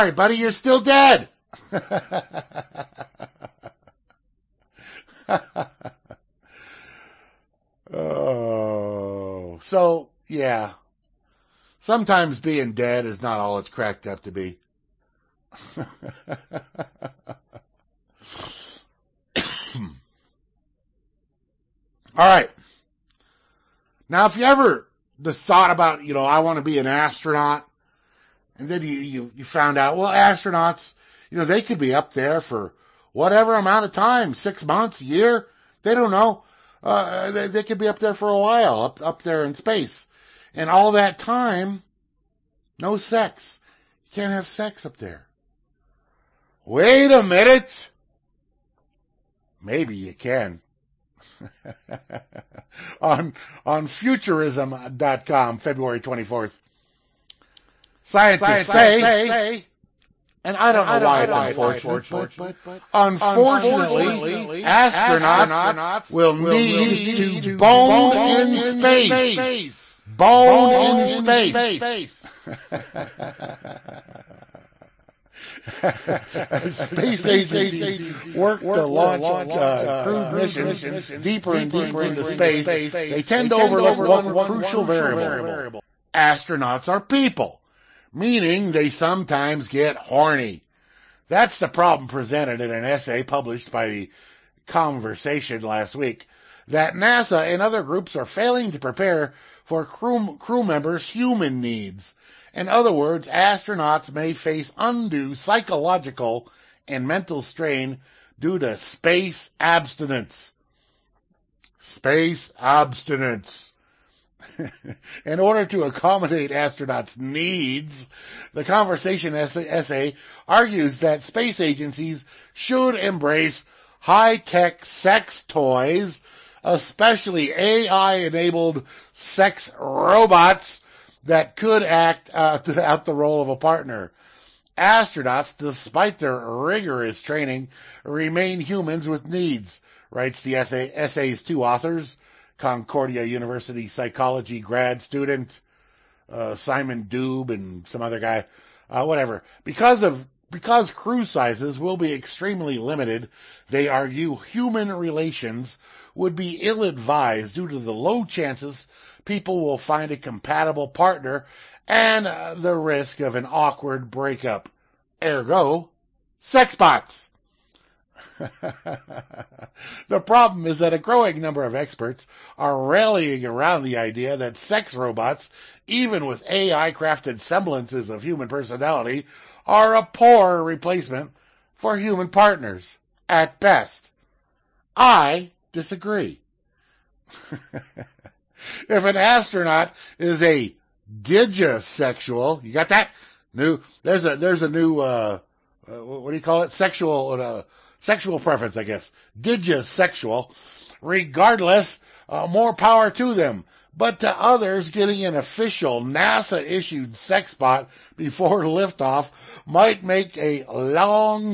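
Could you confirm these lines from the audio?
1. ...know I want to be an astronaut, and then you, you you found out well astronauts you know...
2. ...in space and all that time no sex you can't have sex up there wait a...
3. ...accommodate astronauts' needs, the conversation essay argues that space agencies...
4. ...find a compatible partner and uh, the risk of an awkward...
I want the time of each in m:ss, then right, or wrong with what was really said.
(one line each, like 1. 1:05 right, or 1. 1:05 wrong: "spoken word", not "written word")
1. 0:26 right
2. 0:39 right
3. 1:55 right
4. 2:39 right.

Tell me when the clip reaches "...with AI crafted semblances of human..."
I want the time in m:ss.
2:56.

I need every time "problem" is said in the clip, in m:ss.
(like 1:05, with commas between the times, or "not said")
1:31, 2:50.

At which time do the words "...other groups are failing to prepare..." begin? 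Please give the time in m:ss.
1:37.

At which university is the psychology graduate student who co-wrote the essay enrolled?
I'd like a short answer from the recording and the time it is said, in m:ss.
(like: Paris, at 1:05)
Concordia University, at 2:22.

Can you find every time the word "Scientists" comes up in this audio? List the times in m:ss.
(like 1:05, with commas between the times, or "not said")
0:58.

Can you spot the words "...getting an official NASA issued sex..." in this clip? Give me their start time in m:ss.
3:24.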